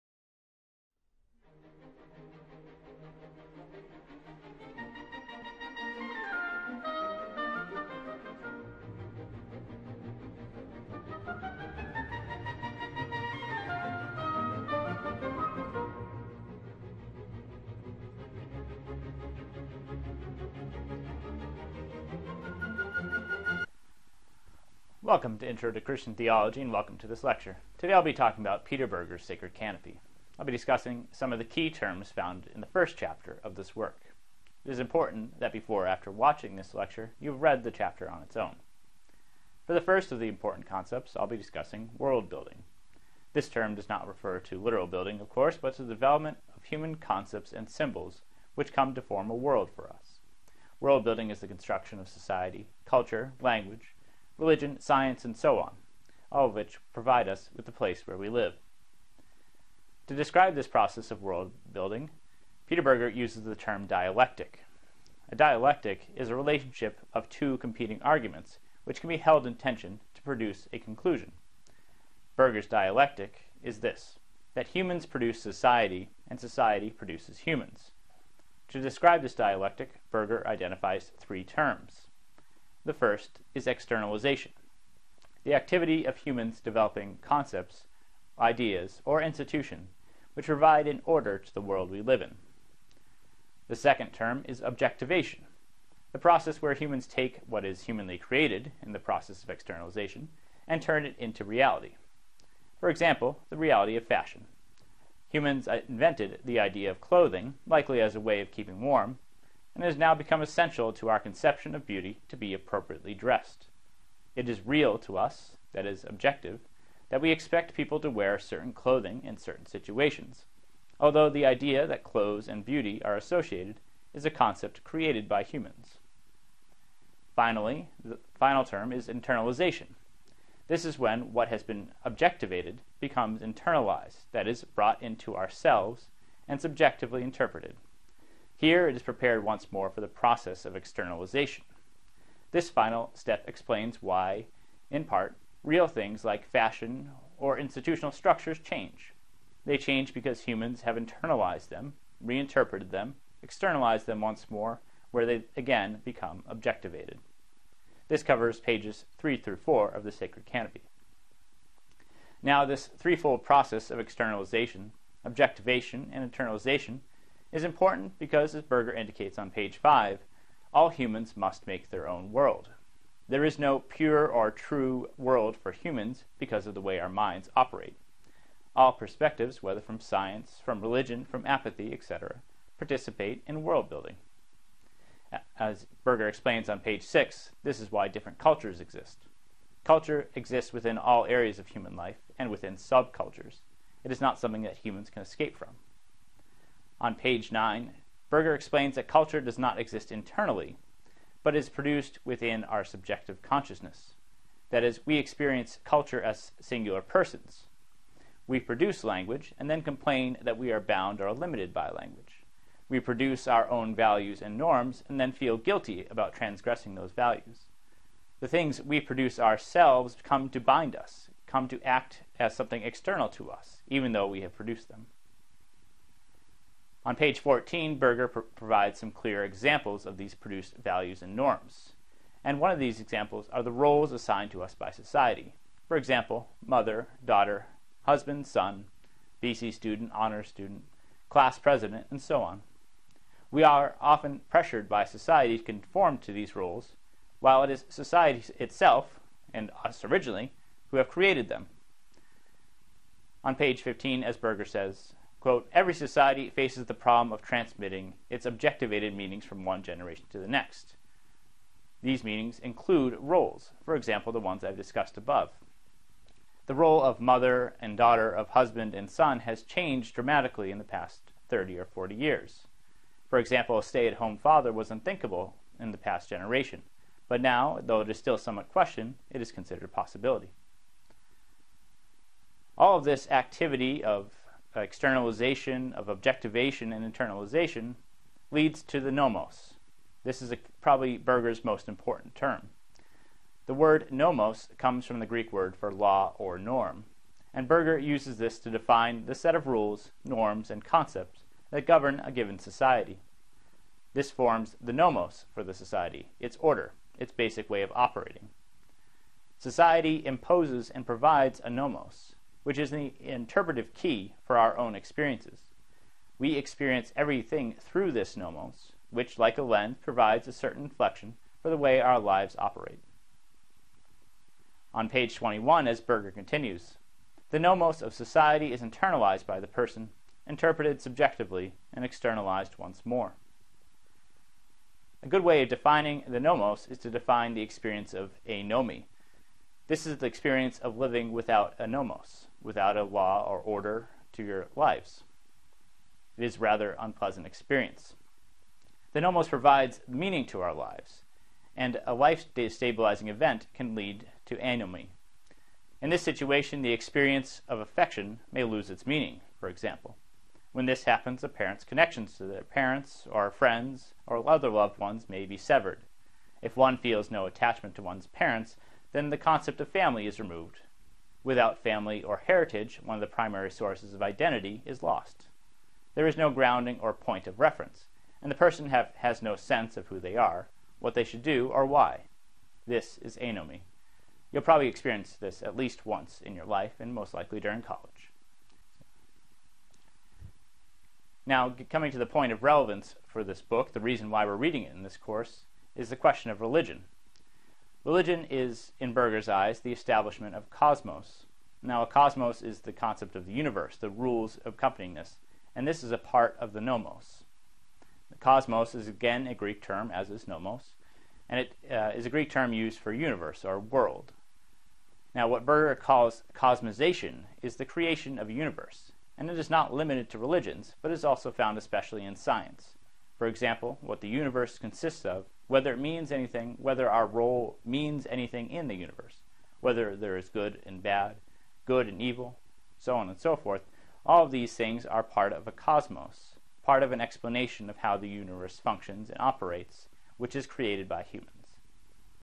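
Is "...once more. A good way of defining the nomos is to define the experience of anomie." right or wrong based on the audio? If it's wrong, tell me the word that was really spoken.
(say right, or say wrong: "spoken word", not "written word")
right.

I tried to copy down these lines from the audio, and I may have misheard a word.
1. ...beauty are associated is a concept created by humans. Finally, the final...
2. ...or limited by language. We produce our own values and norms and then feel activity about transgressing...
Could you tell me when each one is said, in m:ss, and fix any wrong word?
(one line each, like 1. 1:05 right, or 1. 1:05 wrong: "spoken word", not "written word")
1. 2:02 right
2. 3:31 wrong: "guilty", not "activity".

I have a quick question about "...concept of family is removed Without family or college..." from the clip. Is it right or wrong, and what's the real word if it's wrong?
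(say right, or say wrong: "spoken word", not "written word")
wrong: "heritage", not "college".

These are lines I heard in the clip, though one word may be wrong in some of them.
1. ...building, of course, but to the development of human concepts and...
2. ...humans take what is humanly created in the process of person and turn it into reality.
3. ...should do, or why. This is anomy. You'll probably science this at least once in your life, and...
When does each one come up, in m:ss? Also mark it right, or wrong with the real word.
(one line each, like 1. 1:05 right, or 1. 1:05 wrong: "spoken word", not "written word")
1. 0:44 right
2. 1:36 wrong: "externalization", not "person"
3. 6:21 wrong: "experience", not "science".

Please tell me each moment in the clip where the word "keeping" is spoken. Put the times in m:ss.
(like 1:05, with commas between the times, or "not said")
1:48.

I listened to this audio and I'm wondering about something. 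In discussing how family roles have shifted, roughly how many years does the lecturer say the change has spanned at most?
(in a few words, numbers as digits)
40 years.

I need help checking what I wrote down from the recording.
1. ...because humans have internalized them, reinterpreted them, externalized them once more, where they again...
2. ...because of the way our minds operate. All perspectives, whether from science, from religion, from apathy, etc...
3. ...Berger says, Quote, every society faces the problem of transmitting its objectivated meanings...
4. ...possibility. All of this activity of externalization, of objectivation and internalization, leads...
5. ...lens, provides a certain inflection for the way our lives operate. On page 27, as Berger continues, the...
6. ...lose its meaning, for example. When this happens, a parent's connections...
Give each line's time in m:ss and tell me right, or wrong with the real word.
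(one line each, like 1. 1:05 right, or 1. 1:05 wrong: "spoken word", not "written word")
1. 2:30 right
2. 2:56 right
3. 4:14 right
4. 4:39 right
5. 5:19 wrong: "21", not "27"
6. 5:58 right.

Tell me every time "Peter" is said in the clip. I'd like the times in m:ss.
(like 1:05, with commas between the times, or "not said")
0:28, 1:02.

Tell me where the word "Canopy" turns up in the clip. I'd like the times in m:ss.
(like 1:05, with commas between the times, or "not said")
0:29, 2:40.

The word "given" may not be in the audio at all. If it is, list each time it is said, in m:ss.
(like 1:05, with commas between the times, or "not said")
5:02.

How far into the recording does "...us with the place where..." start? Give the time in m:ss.
0:57.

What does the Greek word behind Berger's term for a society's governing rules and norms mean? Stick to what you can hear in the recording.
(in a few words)
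Law or norm.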